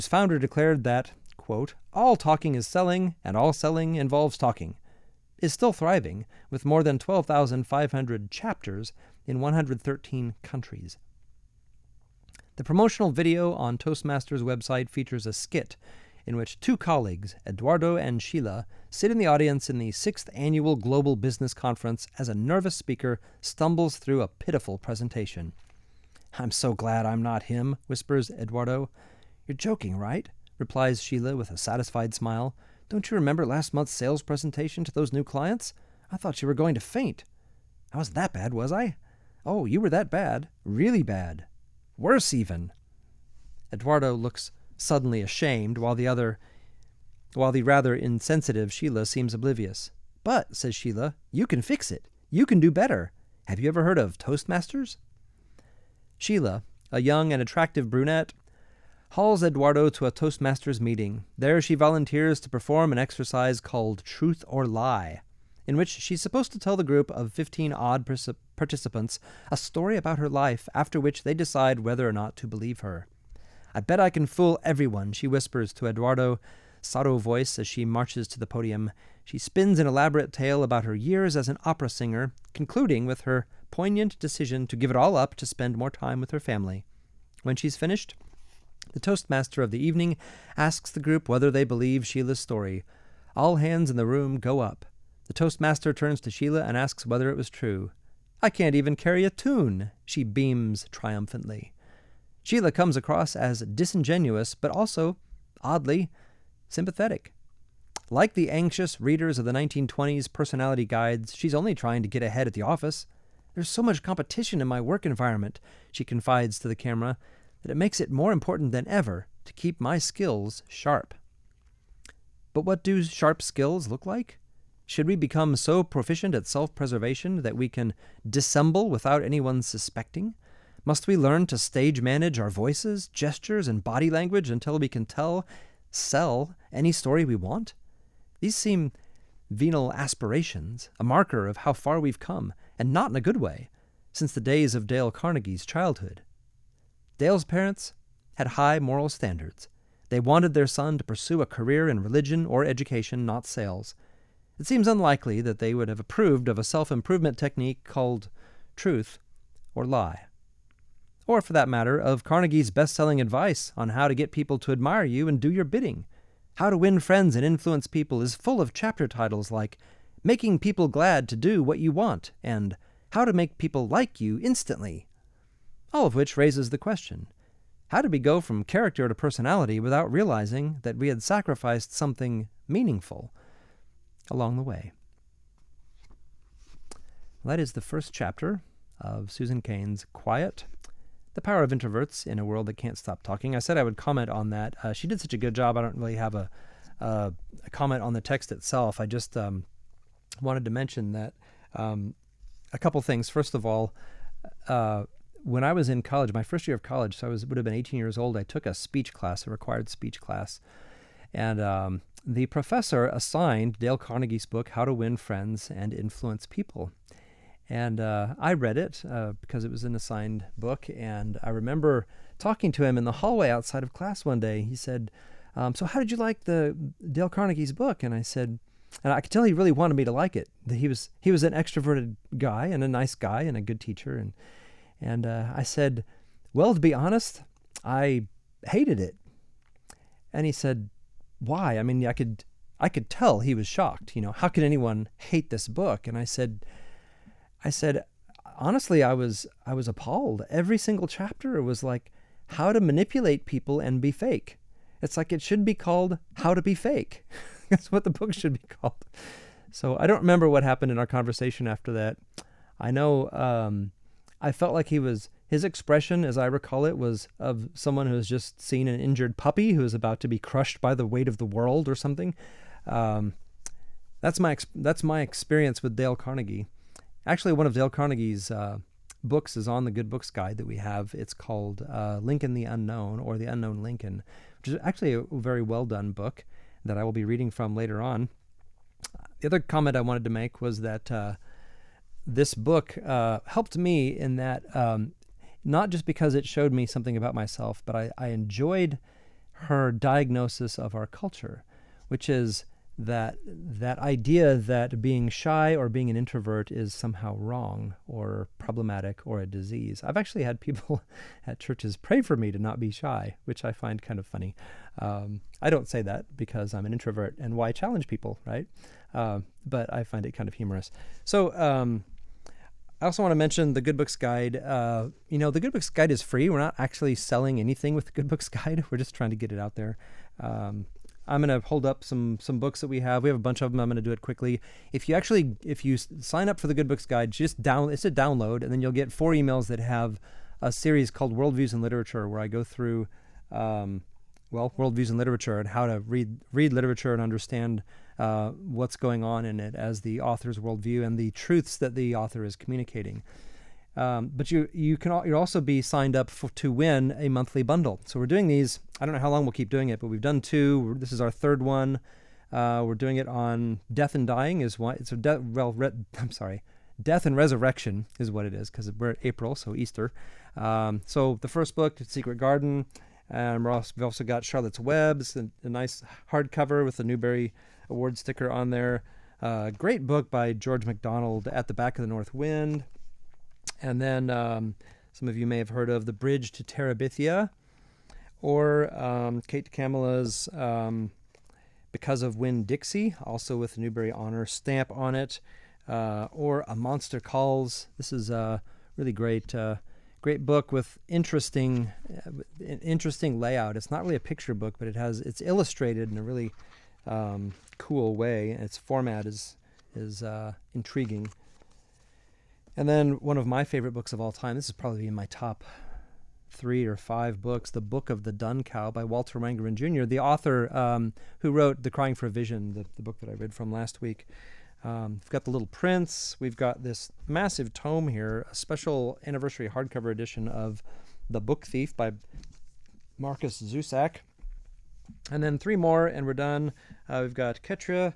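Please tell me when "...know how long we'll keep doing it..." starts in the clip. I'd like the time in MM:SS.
05:59.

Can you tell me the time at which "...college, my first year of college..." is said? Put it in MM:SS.
03:26.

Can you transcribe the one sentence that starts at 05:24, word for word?
Uh, you know, the Good Books Guide is free.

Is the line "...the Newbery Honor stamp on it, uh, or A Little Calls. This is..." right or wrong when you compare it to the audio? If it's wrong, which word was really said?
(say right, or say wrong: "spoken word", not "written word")
wrong: "Monster", not "Little".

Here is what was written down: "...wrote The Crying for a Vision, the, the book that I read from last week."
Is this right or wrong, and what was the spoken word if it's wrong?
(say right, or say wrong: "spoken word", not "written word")
right.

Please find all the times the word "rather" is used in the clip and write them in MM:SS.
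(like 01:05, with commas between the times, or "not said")
00:47.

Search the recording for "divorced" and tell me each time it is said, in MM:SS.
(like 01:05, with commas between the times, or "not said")
not said.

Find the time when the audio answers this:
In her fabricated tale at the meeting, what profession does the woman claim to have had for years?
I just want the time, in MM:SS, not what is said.
01:21.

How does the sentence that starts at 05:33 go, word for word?
We have a bunch of them.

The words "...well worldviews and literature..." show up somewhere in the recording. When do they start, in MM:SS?
05:44.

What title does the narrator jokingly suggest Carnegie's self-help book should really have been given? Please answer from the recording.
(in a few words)
How to Be Fake.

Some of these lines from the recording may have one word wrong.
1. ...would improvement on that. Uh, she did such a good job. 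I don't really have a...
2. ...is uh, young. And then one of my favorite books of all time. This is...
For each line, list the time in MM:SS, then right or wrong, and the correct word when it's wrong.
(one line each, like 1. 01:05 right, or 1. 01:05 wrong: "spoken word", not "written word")
1. 03:13 wrong: "comment", not "improvement"
2. 06:49 wrong: "intriguing", not "young".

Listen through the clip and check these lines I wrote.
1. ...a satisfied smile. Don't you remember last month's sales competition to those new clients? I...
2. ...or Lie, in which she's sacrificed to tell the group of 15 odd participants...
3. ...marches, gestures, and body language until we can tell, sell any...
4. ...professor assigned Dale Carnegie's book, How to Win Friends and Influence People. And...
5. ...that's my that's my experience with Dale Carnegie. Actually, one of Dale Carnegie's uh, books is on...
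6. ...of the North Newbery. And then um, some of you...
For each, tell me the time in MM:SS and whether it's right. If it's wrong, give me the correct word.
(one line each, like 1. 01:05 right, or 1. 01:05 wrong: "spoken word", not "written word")
1. 00:31 wrong: "presentation", not "competition"
2. 01:04 wrong: "supposed", not "sacrificed"
3. 02:12 wrong: "voices", not "marches"
4. 03:32 right
5. 04:34 right
6. 06:21 wrong: "Wind", not "Newbery".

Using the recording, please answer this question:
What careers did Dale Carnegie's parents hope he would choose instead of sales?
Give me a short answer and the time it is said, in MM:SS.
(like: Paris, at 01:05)
religion or education, at 02:32.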